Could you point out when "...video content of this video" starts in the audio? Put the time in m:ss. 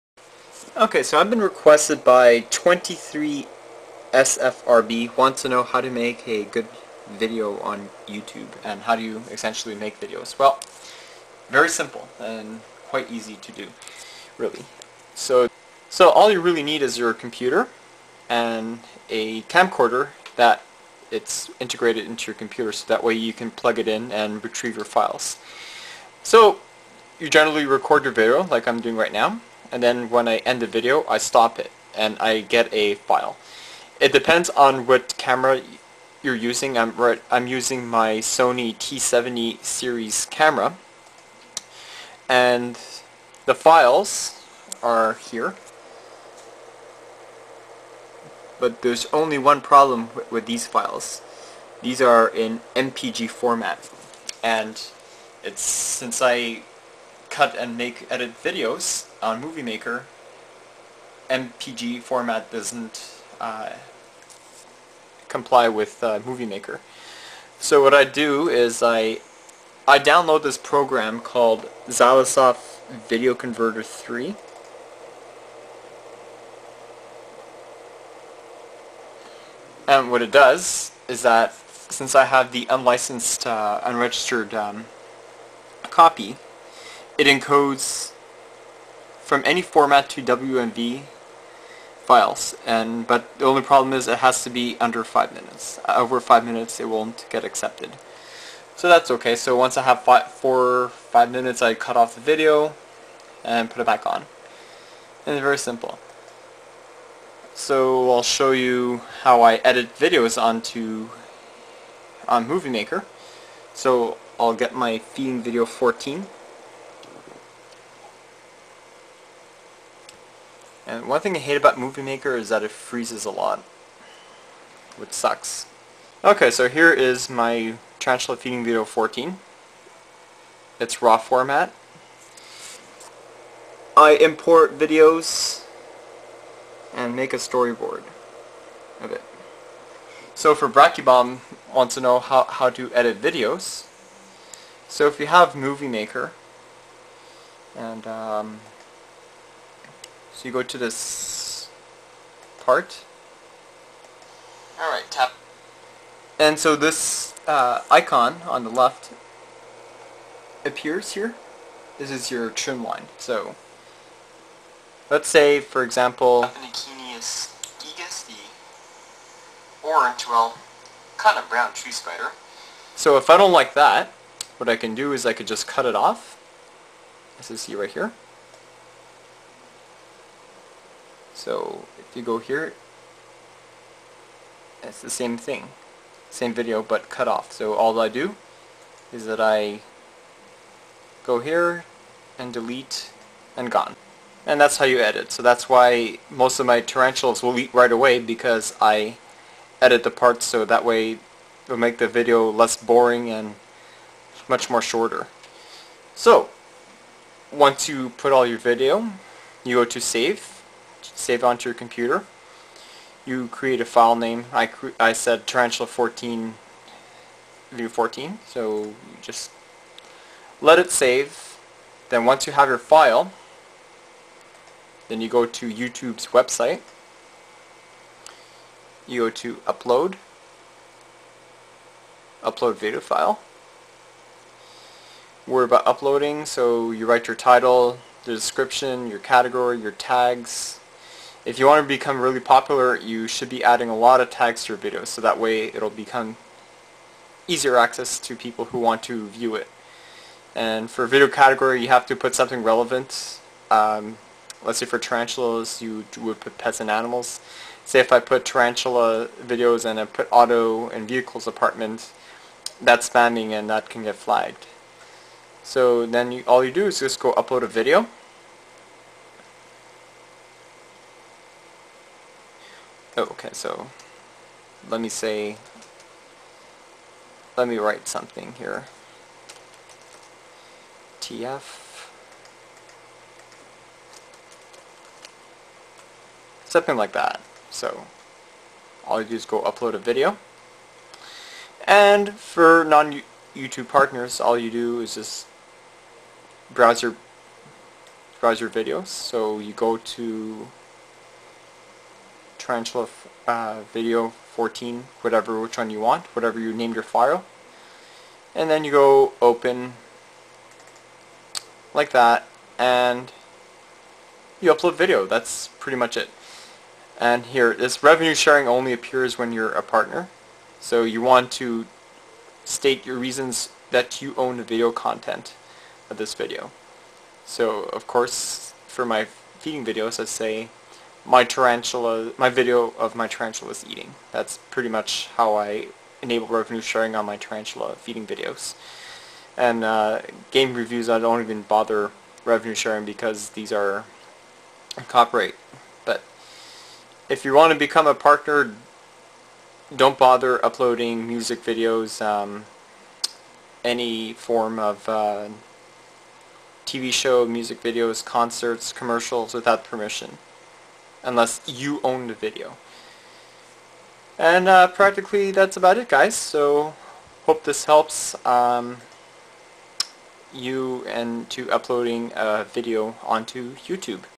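5:24.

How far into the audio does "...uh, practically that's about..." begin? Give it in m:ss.
6:04.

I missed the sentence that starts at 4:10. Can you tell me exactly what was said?
And for video category, you have to put something relevant.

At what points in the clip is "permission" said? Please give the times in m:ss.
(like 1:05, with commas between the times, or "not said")
5:59.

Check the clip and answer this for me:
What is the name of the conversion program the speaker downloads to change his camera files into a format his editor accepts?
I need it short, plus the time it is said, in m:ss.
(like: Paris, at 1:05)
Xilisoft Video Converter 3, at 1:11.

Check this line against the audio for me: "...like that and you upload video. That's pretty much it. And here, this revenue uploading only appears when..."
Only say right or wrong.
wrong.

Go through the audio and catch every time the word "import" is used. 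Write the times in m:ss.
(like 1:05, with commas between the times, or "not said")
2:14.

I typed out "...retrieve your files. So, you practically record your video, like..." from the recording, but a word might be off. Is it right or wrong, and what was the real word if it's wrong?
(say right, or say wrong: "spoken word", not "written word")
wrong: "generally", not "practically".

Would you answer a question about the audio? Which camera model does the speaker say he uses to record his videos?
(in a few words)
Sony T70.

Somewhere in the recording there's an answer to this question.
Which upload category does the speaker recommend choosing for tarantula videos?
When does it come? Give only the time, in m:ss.
4:16.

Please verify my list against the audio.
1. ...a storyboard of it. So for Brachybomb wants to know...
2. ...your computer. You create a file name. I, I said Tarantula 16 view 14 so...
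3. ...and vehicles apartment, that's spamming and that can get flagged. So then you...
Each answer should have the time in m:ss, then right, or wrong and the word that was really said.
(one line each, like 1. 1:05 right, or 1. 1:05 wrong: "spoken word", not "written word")
1. 2:17 right
2. 3:31 wrong: "14", not "16"
3. 4:20 right.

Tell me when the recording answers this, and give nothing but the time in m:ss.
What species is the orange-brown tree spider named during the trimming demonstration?
2:46.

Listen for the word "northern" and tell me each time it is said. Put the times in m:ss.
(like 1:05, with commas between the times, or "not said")
not said.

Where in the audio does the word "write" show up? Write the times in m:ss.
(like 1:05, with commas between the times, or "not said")
3:57, 4:37.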